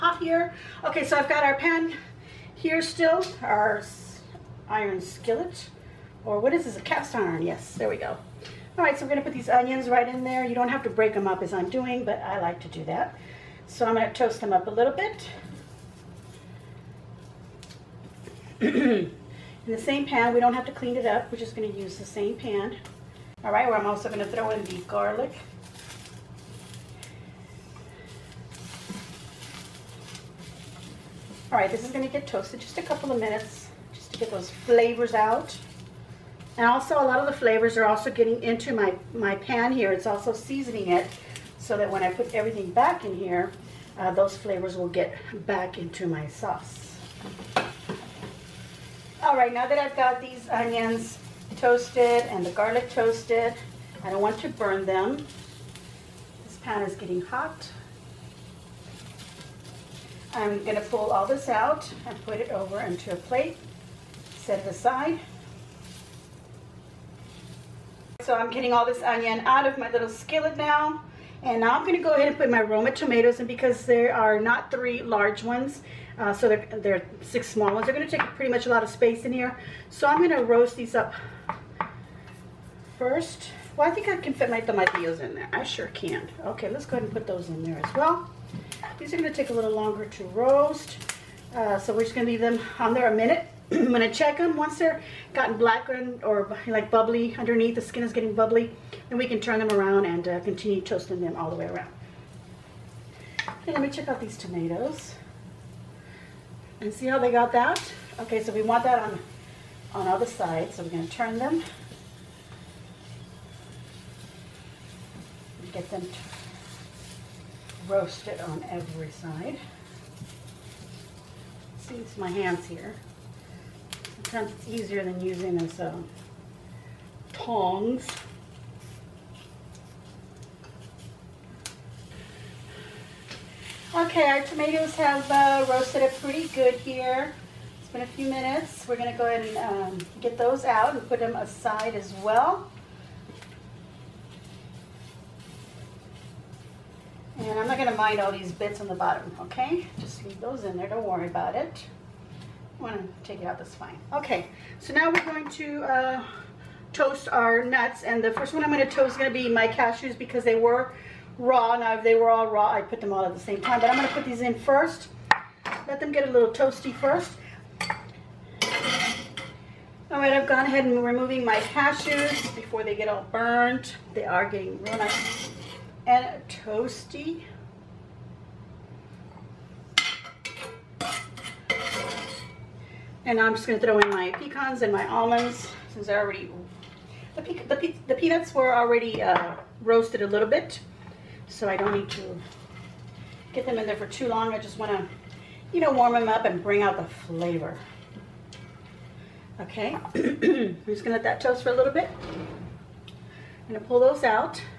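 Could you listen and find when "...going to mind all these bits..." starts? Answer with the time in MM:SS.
02:27.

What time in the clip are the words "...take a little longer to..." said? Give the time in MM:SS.
01:29.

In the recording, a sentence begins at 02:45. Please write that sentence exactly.
Let them get a little toasty first.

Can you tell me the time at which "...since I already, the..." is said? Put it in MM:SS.
03:05.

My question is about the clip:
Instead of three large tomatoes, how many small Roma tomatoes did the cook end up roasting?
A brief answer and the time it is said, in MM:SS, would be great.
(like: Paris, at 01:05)
6, at 01:17.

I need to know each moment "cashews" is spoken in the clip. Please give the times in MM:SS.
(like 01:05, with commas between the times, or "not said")
02:39, 02:51.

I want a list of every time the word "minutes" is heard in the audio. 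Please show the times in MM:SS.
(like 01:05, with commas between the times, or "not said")
00:33, 01:33, 02:18.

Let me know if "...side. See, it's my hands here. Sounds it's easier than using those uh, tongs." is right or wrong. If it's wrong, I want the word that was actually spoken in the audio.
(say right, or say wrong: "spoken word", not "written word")
right.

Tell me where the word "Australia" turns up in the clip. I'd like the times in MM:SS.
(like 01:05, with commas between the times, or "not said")
not said.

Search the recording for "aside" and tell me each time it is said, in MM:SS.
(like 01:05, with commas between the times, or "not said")
01:04, 02:21.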